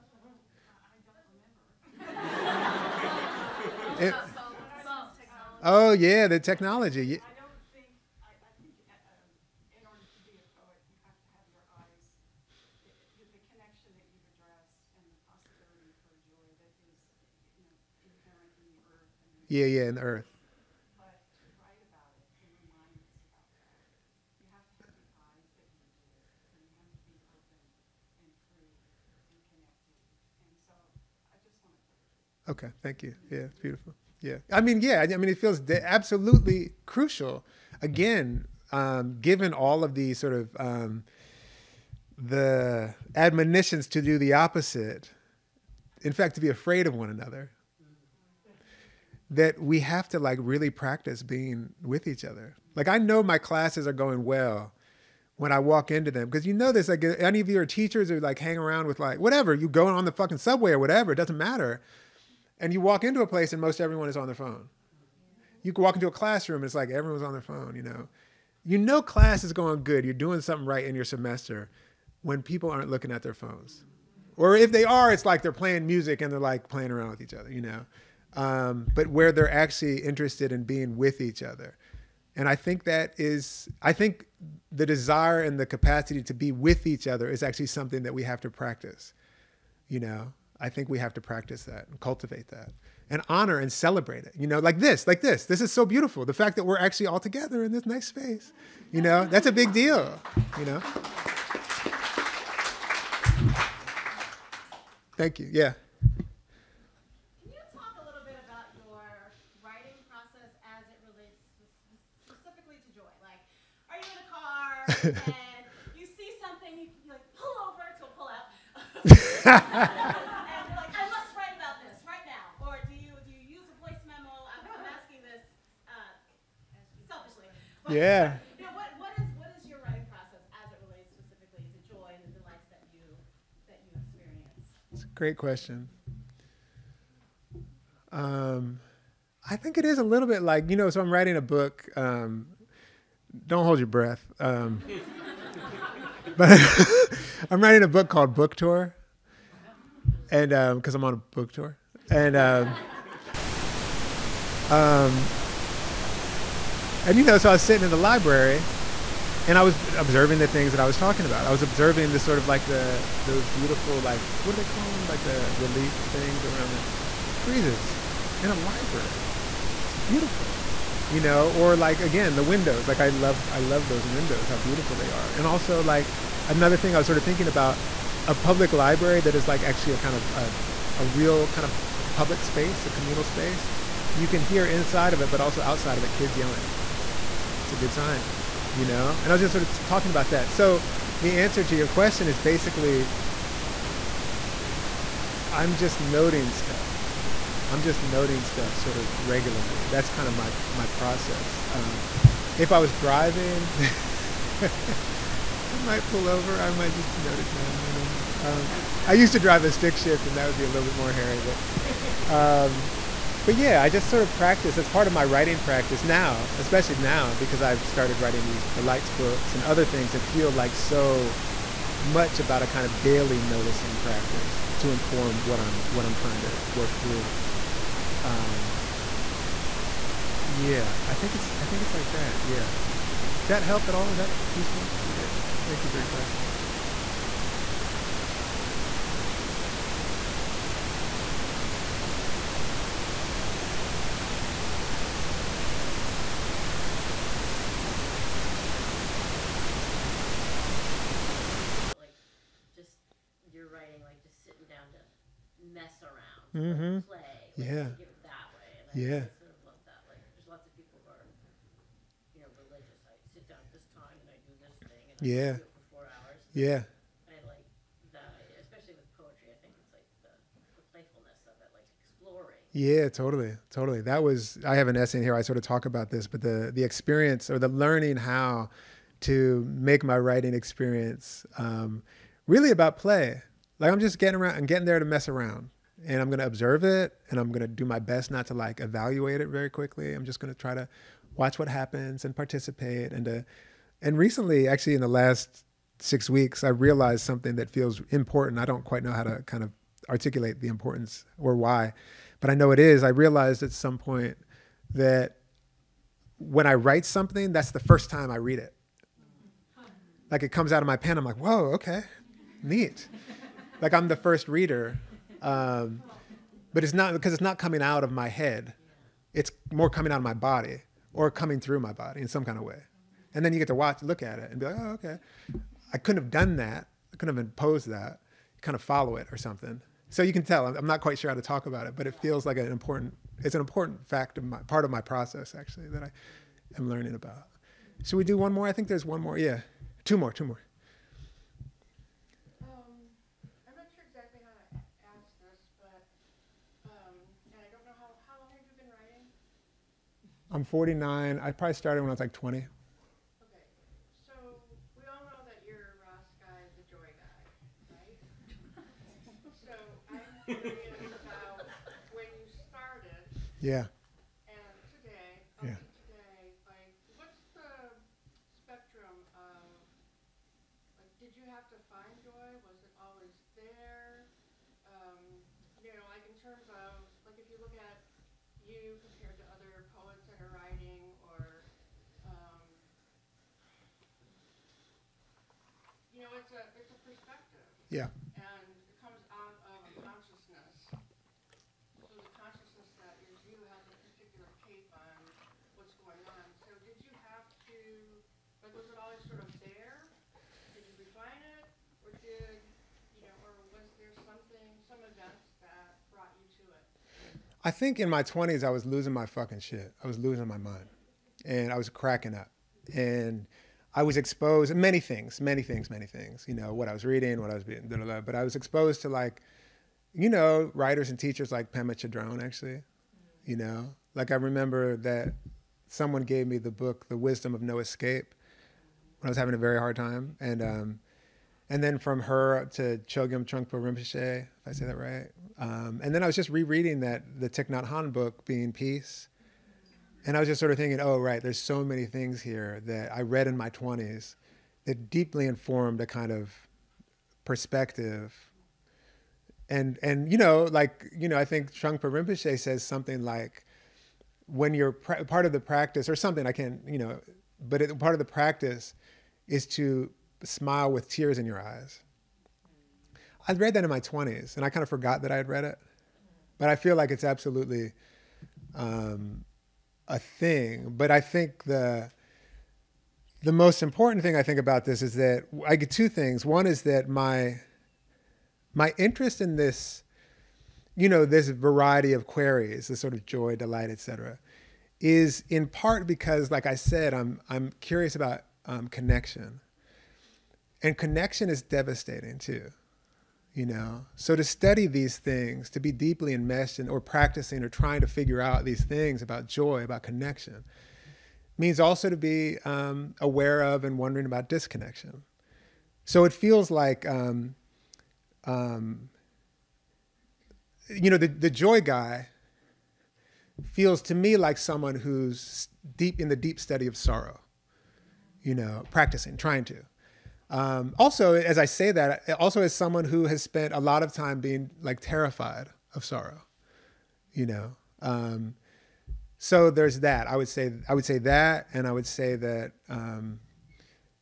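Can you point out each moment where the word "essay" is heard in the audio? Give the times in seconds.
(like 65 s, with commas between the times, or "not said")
274 s.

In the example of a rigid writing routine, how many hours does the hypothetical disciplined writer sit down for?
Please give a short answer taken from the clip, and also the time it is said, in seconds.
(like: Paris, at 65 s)
4, at 265 s.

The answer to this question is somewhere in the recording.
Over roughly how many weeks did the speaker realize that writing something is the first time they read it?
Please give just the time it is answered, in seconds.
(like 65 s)
295 s.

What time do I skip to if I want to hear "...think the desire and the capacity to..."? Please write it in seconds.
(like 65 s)
83 s.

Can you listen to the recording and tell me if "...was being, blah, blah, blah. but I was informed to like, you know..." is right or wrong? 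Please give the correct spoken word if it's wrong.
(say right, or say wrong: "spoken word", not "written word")
wrong: "exposed", not "informed".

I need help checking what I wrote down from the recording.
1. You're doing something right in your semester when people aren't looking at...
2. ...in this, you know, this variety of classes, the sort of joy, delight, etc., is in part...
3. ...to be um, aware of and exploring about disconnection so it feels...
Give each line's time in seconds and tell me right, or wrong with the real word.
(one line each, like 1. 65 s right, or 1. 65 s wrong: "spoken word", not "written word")
1. 70 s right
2. 479 s wrong: "queries", not "classes"
3. 502 s wrong: "wondering", not "exploring".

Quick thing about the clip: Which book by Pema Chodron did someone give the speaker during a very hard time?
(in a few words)
The Wisdom of No Escape.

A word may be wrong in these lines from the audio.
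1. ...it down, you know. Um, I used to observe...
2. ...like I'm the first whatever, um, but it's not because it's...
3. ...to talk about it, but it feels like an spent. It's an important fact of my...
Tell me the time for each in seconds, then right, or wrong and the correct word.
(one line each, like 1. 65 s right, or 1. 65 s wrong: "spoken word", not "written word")
1. 207 s wrong: "drive", not "observe"
2. 313 s wrong: "reader", not "whatever"
3. 331 s wrong: "important", not "spent".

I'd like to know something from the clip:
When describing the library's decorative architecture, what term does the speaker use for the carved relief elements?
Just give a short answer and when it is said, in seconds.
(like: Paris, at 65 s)
friezes, at 167 s.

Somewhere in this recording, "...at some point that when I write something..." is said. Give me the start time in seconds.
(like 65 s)
303 s.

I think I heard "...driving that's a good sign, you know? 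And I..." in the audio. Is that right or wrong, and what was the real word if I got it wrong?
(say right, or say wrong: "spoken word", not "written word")
wrong: "yelling", not "driving".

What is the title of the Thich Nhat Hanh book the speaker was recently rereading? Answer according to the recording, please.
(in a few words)
Being Peace.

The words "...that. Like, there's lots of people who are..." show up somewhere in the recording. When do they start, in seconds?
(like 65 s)
259 s.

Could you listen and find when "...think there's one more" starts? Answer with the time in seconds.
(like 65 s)
338 s.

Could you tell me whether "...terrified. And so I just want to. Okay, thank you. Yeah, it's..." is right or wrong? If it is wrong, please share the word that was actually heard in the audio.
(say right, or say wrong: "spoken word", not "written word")
wrong: "connected", not "terrified".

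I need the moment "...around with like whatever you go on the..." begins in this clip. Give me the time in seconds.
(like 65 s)
58 s.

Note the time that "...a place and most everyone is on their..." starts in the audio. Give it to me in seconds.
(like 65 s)
63 s.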